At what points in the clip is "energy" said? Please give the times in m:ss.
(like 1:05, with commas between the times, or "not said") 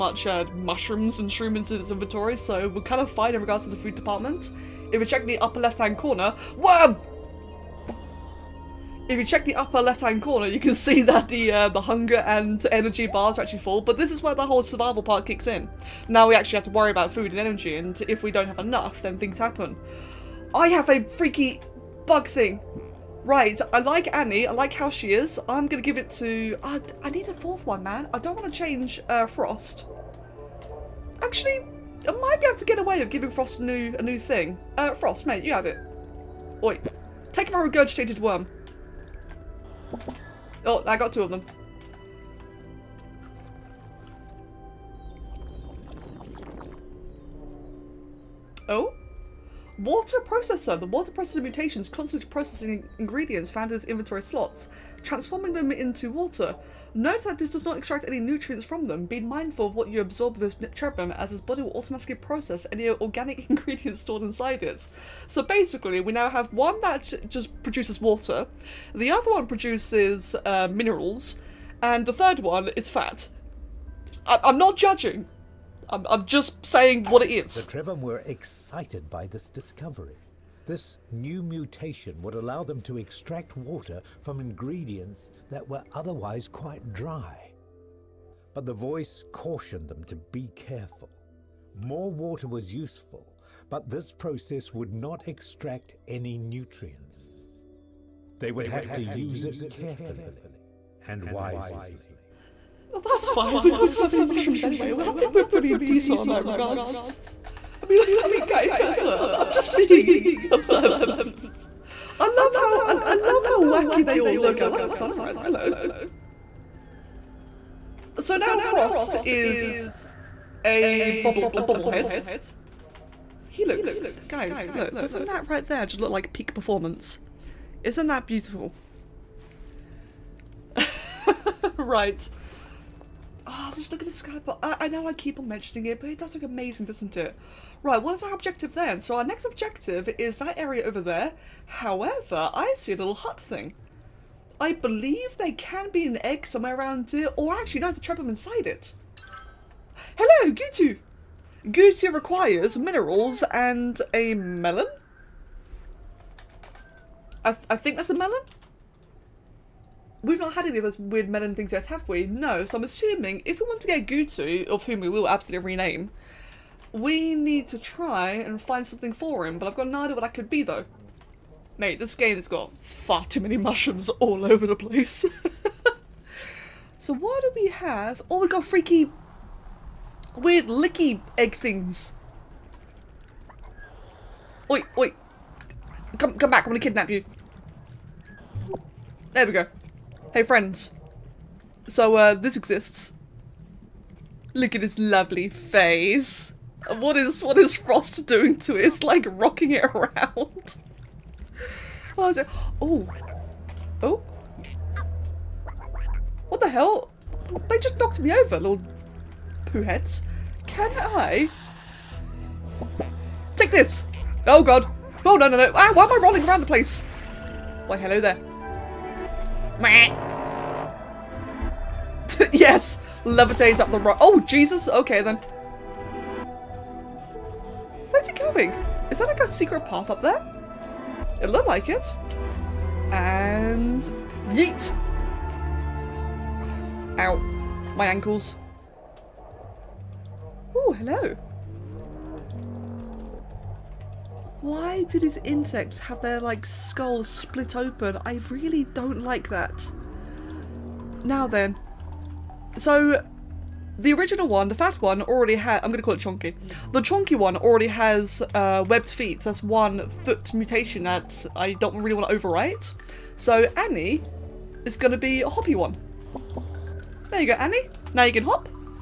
0:12, 0:17.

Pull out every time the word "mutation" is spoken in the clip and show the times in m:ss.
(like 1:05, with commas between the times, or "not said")
0:51, 1:21, 4:20.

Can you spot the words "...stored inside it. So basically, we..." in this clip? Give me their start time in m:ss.
1:04.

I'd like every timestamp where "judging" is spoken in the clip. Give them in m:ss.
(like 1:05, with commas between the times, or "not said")
1:14.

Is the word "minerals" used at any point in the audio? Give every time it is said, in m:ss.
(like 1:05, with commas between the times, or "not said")
1:10, 2:32.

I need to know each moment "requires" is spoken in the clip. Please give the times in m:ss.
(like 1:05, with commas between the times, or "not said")
2:32.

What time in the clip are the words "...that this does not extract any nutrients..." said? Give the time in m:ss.
0:57.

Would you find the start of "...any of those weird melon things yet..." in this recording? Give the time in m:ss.
2:40.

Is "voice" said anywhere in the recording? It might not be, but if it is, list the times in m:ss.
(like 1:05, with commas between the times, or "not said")
1:28.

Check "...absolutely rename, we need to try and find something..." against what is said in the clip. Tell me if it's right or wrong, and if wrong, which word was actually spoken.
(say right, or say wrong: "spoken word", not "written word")
right.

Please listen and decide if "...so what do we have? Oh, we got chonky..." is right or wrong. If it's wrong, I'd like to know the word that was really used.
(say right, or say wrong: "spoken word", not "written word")
wrong: "freaky", not "chonky".